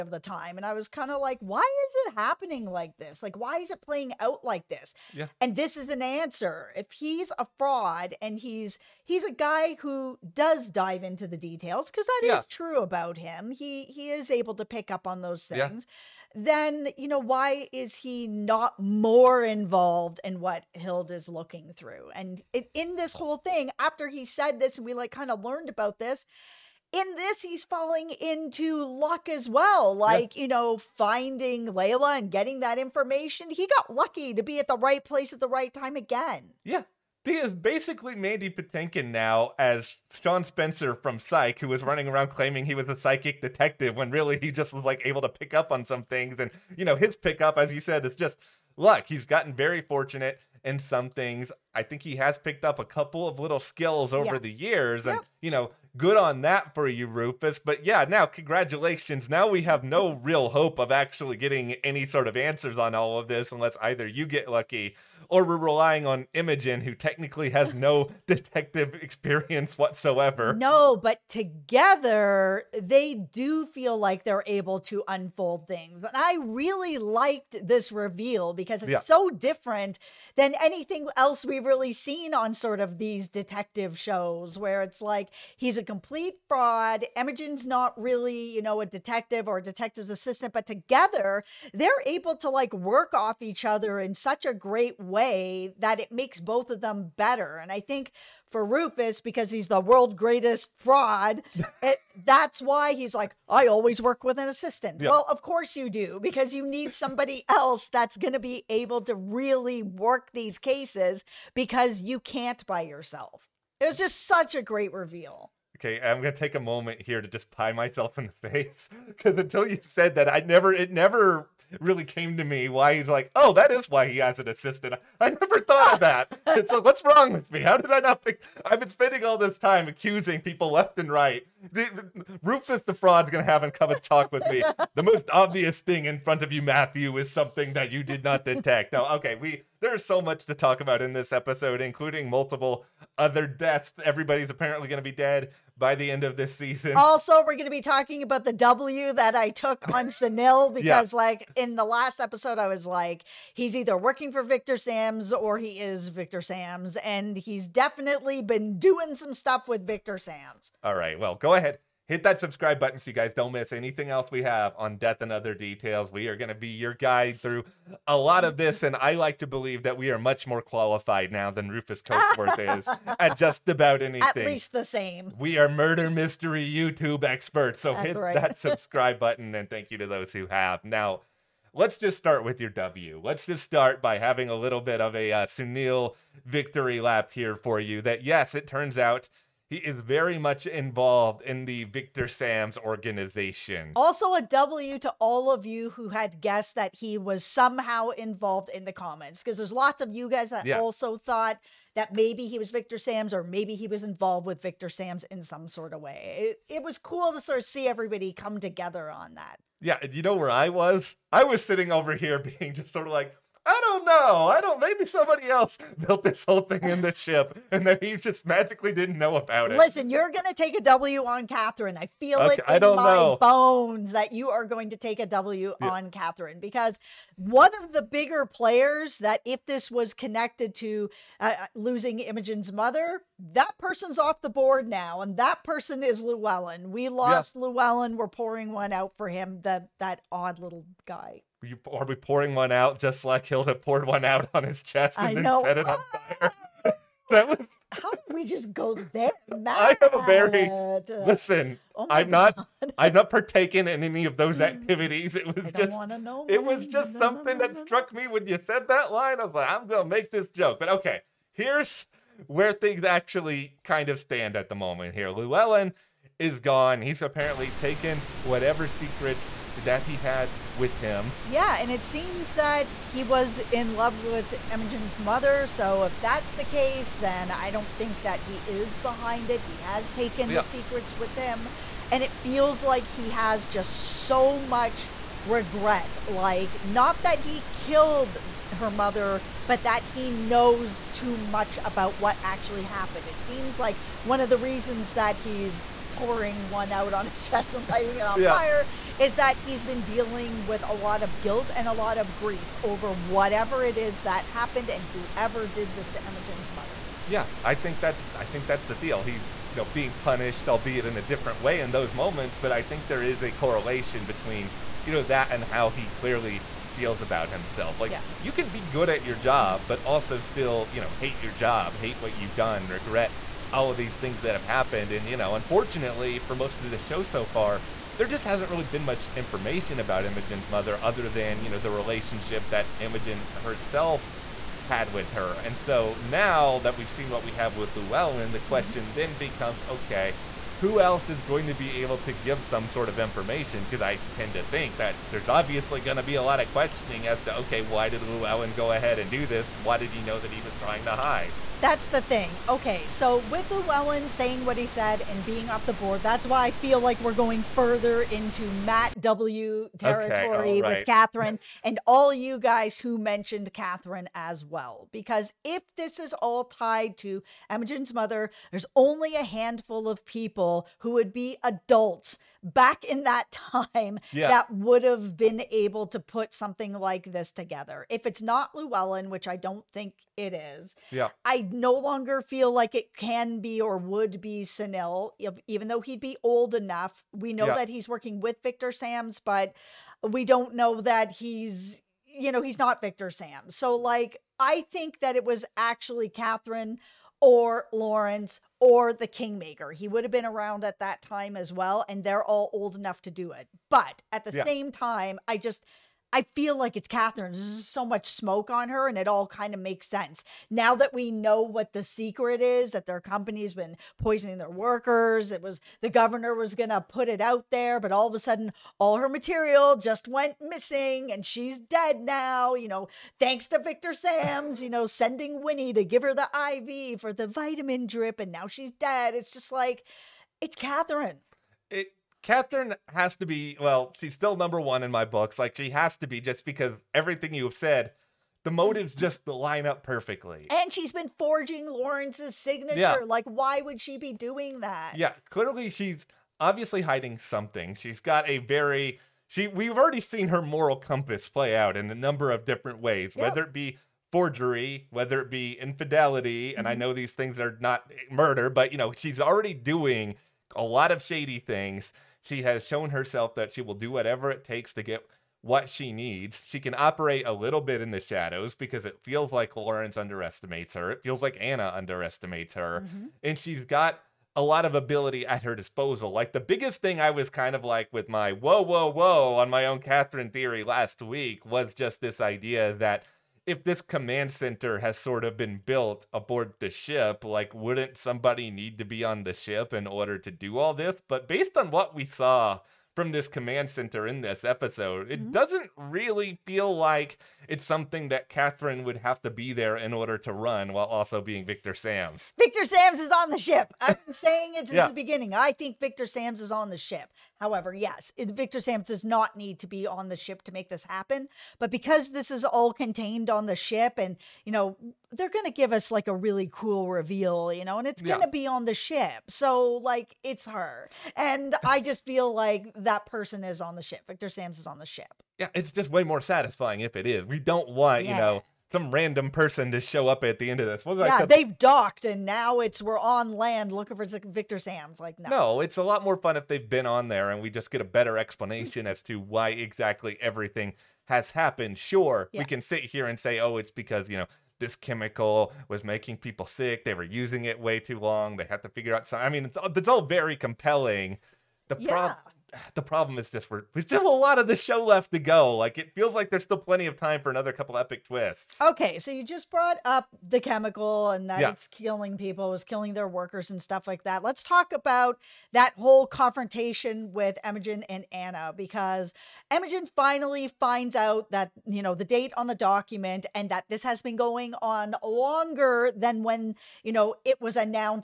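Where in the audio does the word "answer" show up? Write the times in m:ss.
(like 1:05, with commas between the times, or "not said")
0:06, 1:02.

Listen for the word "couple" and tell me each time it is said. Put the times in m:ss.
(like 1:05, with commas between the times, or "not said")
0:52, 9:17.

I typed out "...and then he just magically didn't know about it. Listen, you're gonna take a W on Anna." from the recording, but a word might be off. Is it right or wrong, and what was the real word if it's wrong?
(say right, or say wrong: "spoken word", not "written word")
wrong: "Catherine", not "Anna".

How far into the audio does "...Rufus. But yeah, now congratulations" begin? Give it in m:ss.
0:57.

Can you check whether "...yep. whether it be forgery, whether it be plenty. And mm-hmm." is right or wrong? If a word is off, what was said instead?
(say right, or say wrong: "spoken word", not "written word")
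wrong: "infidelity", not "plenty".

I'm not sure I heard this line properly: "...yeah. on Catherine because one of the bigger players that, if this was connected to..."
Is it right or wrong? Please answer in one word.
right.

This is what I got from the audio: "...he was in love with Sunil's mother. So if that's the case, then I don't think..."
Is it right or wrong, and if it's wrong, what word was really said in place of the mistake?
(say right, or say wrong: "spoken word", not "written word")
wrong: "Imogen", not "Sunil".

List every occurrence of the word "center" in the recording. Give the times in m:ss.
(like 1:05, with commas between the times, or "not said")
8:04, 8:13.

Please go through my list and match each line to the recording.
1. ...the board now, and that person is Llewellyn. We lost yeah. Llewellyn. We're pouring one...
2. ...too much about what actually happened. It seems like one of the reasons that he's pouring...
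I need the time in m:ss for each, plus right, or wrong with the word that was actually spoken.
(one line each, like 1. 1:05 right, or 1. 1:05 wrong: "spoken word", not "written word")
1. 3:54 right
2. 4:51 right.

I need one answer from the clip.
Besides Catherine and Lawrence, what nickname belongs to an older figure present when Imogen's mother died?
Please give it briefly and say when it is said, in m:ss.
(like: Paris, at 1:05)
the Kingmaker, at 6:39.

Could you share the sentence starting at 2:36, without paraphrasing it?
And he's definitely been doing some stuff with Victor Sams.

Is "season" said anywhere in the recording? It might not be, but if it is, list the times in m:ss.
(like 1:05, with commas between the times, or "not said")
2:26.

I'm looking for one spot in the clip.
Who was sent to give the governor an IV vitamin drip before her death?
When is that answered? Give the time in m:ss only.
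7:05.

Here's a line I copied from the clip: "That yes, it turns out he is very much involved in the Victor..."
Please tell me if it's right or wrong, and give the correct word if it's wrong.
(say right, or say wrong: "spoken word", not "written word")
right.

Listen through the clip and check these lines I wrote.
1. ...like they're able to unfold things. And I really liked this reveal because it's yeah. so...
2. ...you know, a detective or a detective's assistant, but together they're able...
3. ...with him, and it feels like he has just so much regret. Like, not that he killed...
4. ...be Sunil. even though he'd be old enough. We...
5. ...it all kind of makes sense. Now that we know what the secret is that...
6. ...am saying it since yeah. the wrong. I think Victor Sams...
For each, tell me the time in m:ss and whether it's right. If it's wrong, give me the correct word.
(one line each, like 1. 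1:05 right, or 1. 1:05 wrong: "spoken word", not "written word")
1. 1:13 right
2. 1:28 right
3. 4:41 right
4. 6:24 right
5. 6:49 right
6. 8:24 wrong: "beginning", not "wrong".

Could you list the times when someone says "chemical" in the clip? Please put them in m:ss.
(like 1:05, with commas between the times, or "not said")
9:04, 9:20.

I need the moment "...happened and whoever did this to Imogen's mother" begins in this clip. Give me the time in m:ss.
5:04.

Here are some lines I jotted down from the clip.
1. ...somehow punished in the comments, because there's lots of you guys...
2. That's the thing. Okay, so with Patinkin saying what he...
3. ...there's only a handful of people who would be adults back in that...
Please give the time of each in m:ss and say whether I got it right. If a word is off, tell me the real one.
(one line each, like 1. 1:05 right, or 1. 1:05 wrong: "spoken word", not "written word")
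1. 3:17 wrong: "involved", not "punished"
2. 5:51 wrong: "Llewellyn", not "Patinkin"
3. 6:08 right.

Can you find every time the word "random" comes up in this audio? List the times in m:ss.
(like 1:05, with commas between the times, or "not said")
8:49.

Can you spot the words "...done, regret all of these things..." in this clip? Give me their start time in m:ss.
5:22.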